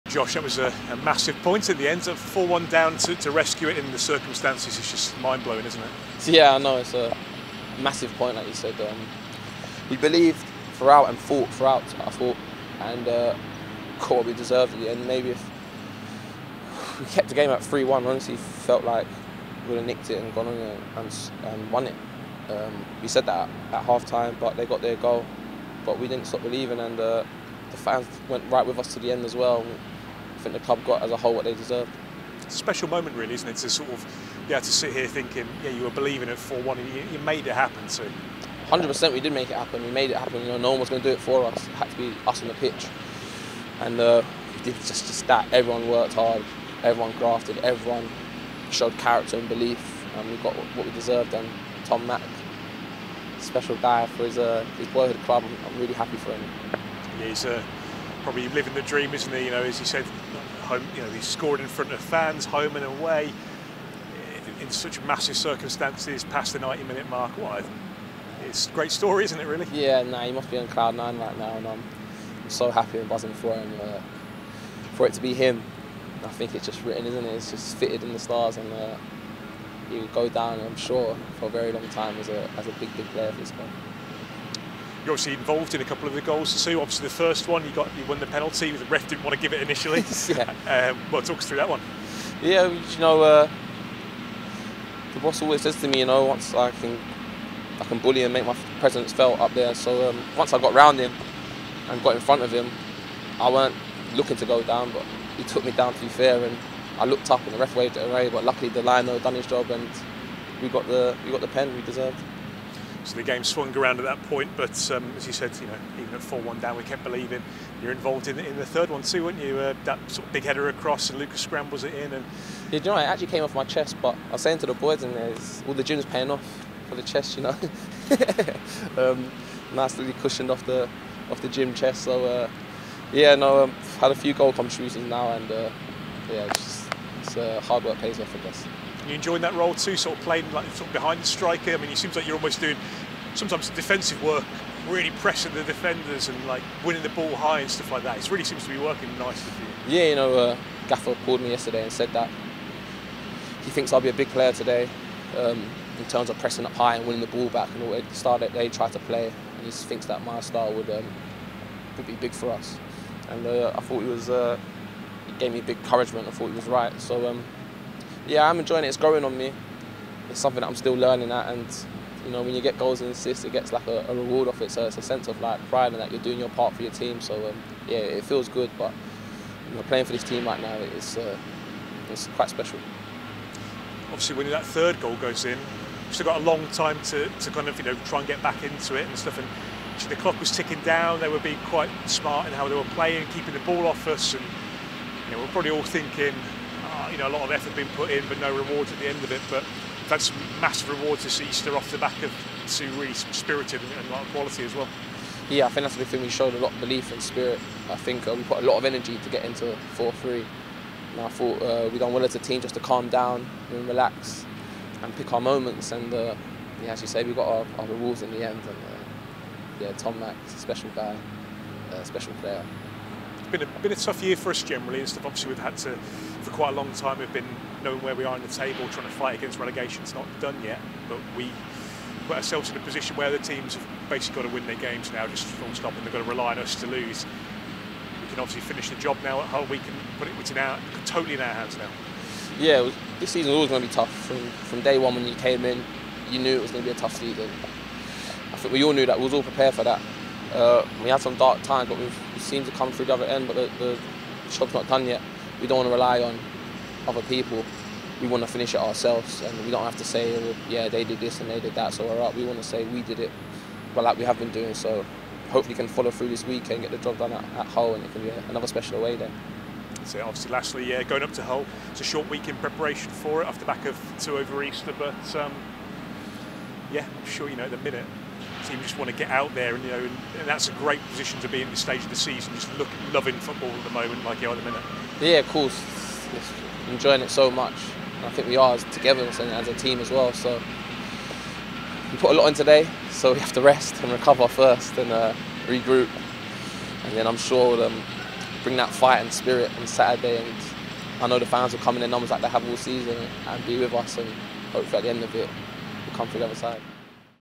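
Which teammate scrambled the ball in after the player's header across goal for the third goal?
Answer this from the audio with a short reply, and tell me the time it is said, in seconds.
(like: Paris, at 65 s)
Lucas, at 121 s.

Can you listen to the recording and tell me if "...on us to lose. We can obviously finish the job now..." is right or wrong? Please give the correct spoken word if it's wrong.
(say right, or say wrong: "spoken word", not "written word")
right.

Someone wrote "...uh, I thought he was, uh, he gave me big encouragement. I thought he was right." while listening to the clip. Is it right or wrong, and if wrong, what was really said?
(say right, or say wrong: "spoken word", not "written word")
right.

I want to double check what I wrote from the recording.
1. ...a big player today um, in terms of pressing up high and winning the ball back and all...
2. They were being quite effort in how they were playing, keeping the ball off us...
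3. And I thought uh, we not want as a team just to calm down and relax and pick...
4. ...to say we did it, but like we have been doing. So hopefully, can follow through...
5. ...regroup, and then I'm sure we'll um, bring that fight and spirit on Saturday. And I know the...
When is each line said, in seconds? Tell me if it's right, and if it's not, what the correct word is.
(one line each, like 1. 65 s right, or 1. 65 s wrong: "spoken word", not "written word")
1. 154 s right
2. 191 s wrong: "smart", not "effort"
3. 211 s right
4. 262 s right
5. 295 s right.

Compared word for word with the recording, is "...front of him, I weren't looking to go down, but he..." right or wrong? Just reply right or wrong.
right.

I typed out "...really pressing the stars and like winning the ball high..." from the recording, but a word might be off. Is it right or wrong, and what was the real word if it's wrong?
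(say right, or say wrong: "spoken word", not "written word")
wrong: "defenders", not "stars".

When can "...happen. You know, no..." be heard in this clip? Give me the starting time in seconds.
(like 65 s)
40 s.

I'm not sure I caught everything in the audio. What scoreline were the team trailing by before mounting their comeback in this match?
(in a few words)
4-1.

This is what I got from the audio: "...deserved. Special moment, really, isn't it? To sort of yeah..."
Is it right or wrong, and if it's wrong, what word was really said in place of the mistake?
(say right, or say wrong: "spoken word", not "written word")
right.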